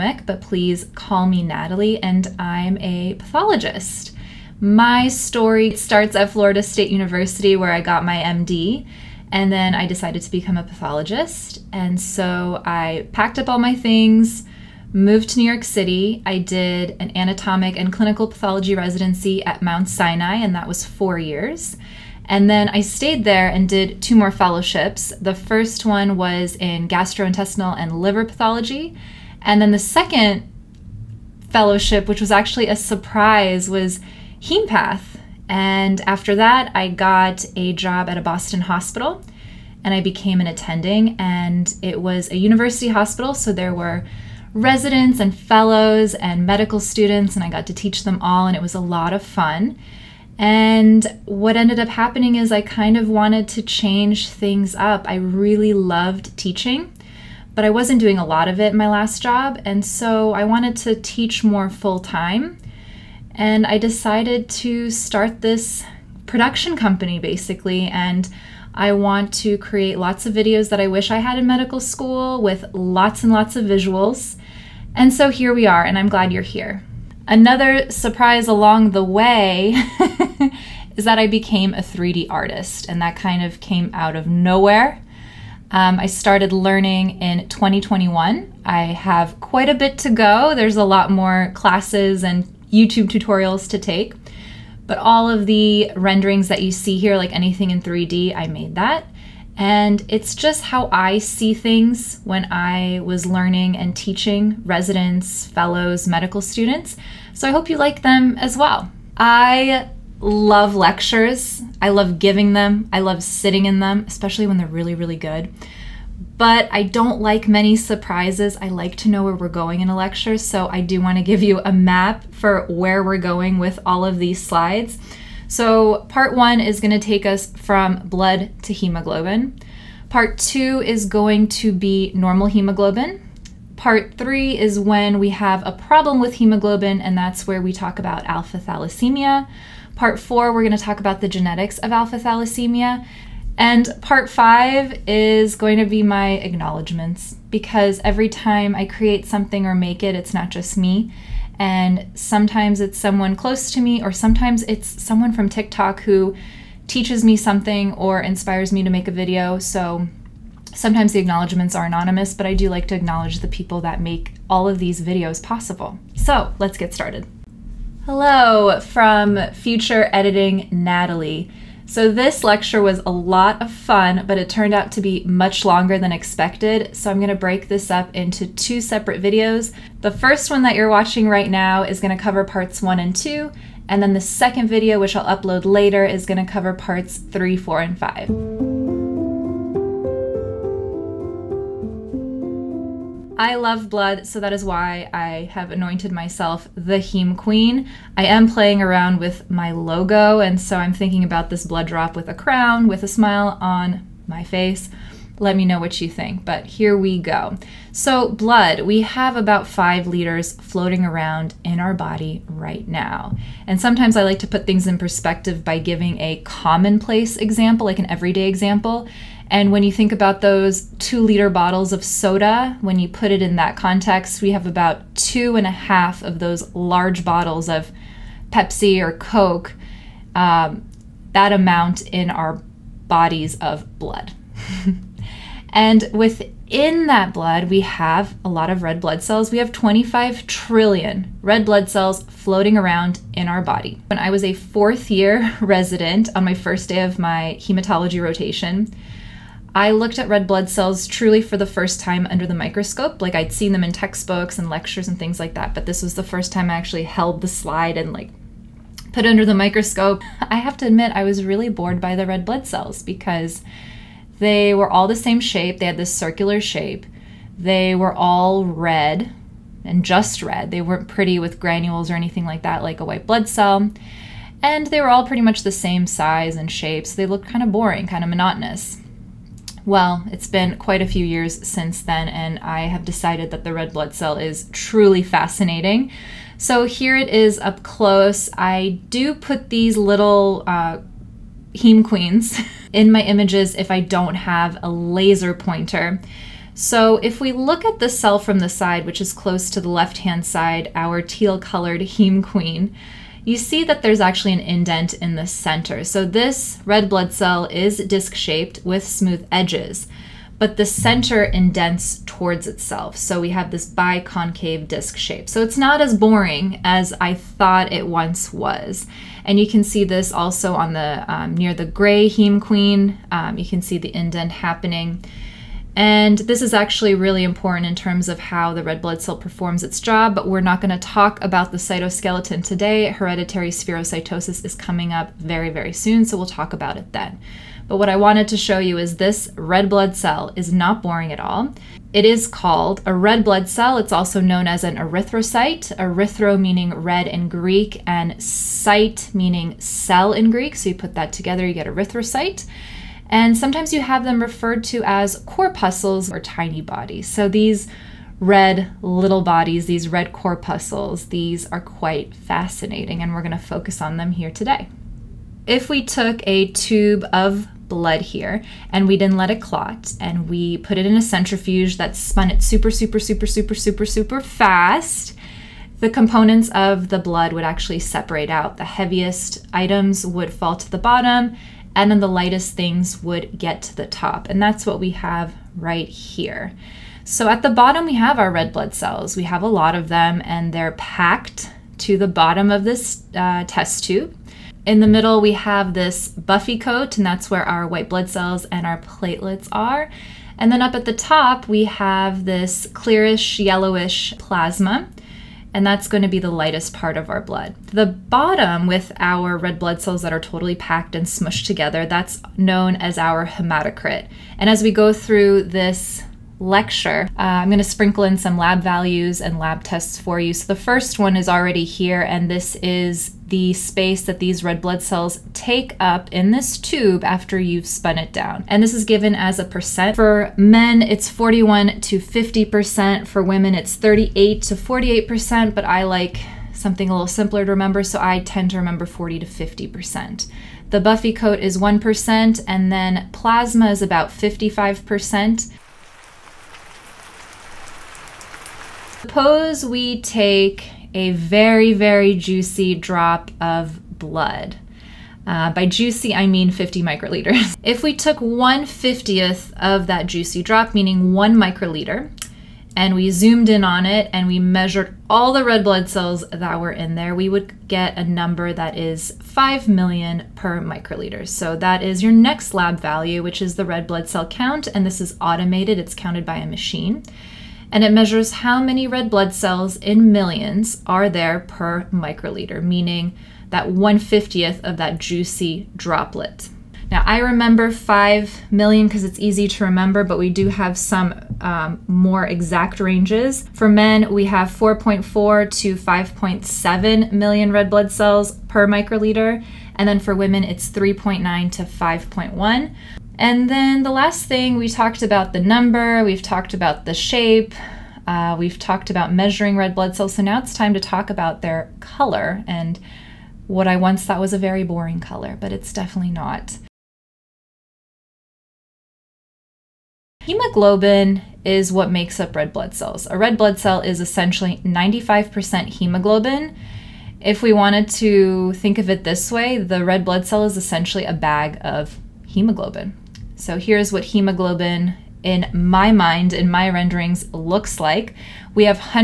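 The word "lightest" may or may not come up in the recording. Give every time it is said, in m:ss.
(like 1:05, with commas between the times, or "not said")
6:22, 6:46.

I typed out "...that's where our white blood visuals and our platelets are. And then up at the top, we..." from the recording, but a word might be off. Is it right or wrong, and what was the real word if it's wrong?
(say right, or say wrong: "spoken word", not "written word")
wrong: "cells", not "visuals".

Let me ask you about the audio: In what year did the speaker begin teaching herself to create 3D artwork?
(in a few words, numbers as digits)
2021.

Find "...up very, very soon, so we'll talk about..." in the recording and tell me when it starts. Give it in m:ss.
5:35.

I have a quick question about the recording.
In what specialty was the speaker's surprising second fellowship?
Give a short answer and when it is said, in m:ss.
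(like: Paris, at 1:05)
hempath, at 0:34.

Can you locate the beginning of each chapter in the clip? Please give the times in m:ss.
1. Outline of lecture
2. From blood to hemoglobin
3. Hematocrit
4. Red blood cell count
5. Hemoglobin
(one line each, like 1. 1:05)
1. 1:50
2. 3:08
3. 6:53
4. 7:50
5. 8:41.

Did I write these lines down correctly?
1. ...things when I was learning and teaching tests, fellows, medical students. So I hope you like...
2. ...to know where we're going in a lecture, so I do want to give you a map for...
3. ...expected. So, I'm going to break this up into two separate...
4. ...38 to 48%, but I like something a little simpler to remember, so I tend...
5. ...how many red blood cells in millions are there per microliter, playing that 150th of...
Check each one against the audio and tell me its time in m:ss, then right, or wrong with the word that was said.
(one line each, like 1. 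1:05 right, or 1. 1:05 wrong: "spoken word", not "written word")
1. 1:41 wrong: "residents", not "tests"
2. 1:58 right
3. 2:56 right
4. 7:13 right
5. 7:58 wrong: "meaning", not "playing".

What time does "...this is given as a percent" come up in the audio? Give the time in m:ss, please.
7:08.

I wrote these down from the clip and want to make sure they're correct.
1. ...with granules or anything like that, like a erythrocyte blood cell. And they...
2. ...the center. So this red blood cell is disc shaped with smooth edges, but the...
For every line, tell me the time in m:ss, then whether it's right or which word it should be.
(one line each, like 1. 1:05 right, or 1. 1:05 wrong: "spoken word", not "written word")
1. 4:31 wrong: "white", not "erythrocyte"
2. 5:05 right.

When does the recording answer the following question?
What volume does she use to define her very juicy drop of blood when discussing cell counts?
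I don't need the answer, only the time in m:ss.
7:36.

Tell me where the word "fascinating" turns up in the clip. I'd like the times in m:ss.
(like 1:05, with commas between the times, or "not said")
4:45, 6:02.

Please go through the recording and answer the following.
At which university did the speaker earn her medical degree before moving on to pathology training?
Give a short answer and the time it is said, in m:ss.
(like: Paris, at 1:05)
Florida State University, at 0:06.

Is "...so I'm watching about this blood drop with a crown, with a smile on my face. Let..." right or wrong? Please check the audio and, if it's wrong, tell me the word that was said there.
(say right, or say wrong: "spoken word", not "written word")
wrong: "thinking", not "watching".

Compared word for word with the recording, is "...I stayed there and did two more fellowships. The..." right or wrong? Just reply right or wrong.
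right.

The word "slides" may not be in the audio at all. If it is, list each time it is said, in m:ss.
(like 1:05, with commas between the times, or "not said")
2:04, 4:17.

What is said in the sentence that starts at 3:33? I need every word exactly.
And sometimes I like to put things in perspective by giving a commonplace example, like an everyday example.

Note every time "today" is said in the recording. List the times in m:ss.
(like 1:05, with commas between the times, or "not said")
5:32, 6:04.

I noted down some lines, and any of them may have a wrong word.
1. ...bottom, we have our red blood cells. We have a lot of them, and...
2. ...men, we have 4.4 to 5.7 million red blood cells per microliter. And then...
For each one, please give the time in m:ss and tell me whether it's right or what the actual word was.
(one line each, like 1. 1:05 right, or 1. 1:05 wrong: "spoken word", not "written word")
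1. 6:27 right
2. 8:13 right.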